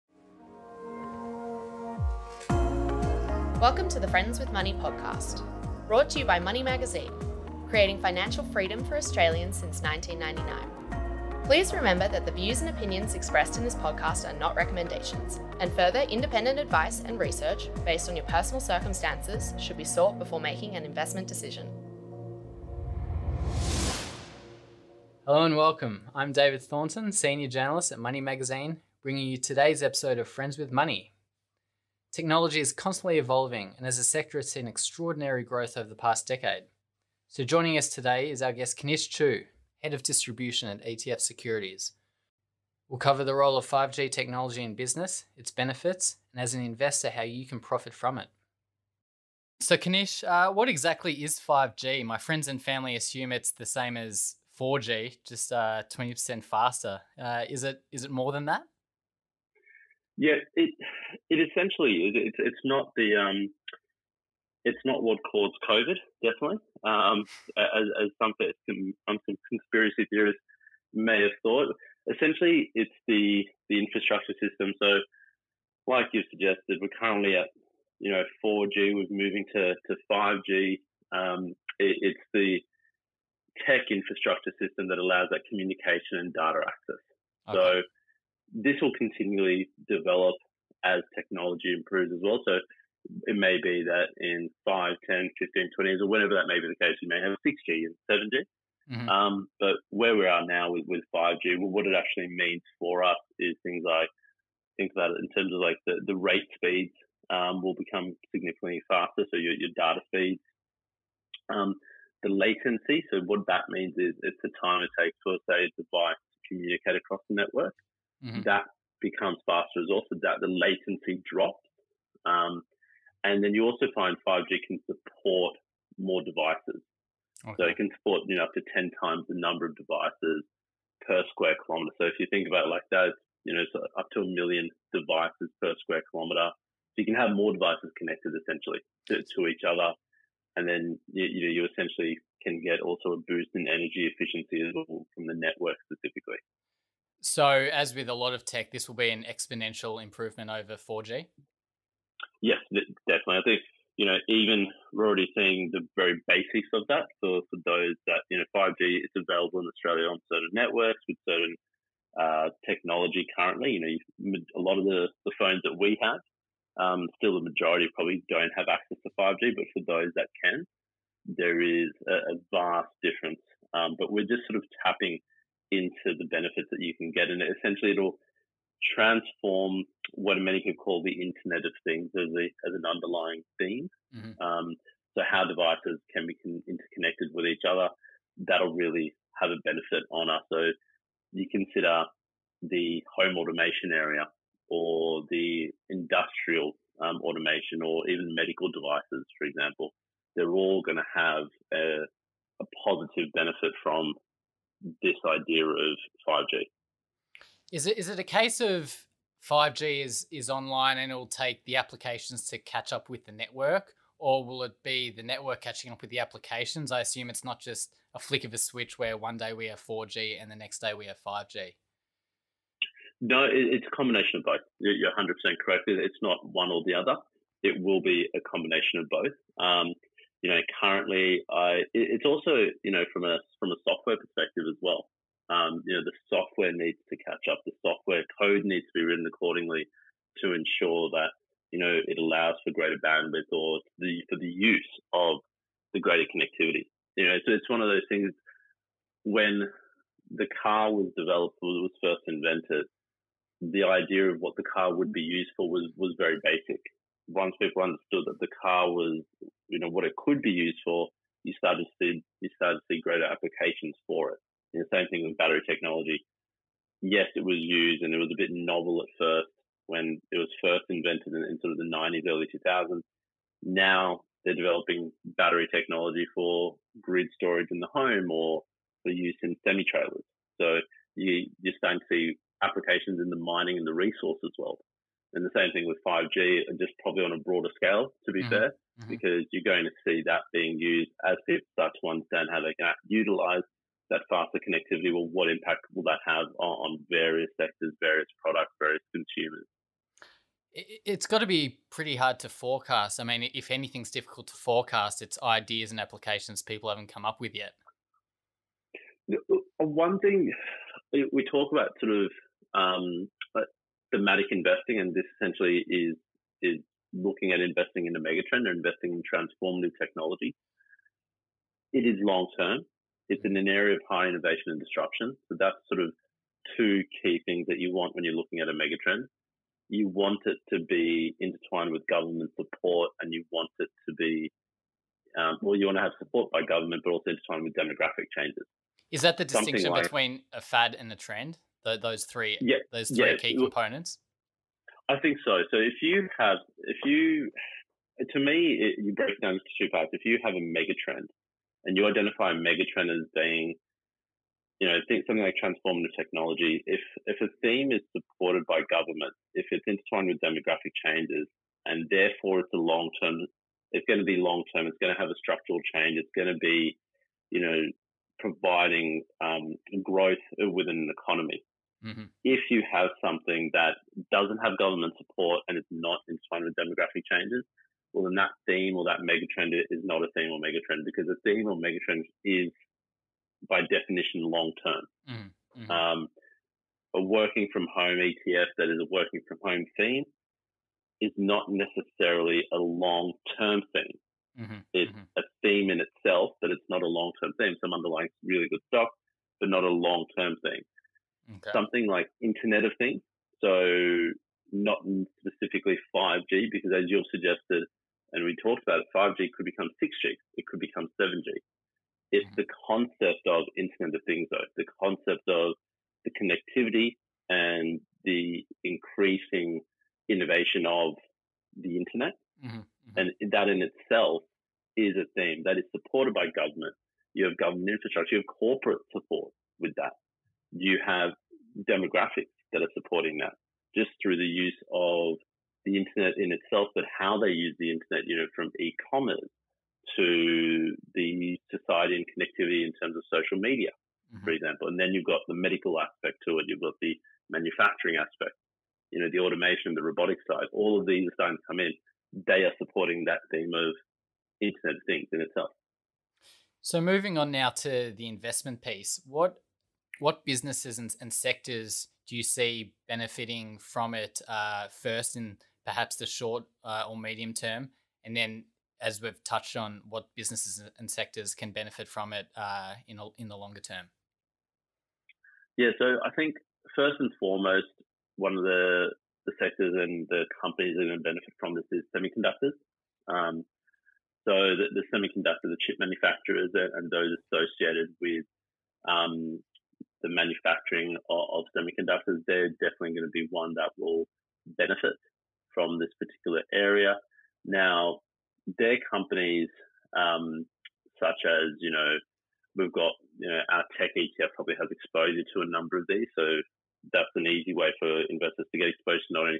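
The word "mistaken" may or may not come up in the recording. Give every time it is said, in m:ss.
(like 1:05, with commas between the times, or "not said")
not said.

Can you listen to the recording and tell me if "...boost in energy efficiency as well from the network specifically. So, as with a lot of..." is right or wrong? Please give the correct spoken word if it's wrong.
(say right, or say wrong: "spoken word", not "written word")
right.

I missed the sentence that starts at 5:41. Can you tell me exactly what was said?
The, those three, yeah, those three yeah, key components.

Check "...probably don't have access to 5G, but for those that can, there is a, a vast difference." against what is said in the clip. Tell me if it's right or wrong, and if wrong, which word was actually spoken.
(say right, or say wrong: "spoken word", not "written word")
right.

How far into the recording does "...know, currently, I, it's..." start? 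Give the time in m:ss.
3:50.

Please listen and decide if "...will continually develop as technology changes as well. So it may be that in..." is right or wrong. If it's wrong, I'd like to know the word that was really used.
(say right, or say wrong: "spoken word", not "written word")
wrong: "improves", not "changes".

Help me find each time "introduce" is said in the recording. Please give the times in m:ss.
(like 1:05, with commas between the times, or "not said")
not said.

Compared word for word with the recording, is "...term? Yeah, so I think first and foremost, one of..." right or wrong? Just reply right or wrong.
right.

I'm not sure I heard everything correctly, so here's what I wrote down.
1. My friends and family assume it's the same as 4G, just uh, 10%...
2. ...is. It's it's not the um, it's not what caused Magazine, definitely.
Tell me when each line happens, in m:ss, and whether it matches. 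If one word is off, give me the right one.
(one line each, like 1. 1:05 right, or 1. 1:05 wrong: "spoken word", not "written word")
1. 0:52 wrong: "20", not "10"
2. 1:02 wrong: "COVID", not "Magazine".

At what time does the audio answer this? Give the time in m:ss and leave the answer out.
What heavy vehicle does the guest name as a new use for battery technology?
4:39.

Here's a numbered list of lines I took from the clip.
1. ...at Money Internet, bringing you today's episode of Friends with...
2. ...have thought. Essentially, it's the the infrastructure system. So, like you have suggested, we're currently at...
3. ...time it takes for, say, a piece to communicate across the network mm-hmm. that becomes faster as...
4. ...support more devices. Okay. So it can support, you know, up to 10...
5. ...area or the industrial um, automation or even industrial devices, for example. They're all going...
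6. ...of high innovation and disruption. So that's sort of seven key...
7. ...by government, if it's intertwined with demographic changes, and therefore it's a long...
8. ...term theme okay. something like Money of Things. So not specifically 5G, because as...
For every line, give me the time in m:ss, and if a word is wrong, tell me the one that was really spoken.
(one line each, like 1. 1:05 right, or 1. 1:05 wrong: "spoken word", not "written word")
1. 0:27 wrong: "Magazine", not "Internet"
2. 1:11 right
3. 1:54 wrong: "device", not "piece"
4. 2:04 right
5. 3:13 wrong: "medical", not "industrial"
6. 5:23 wrong: "two", not "seven"
7. 5:58 right
8. 6:40 wrong: "Internet", not "Money".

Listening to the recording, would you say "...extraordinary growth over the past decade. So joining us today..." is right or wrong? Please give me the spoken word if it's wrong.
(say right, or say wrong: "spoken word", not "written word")
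right.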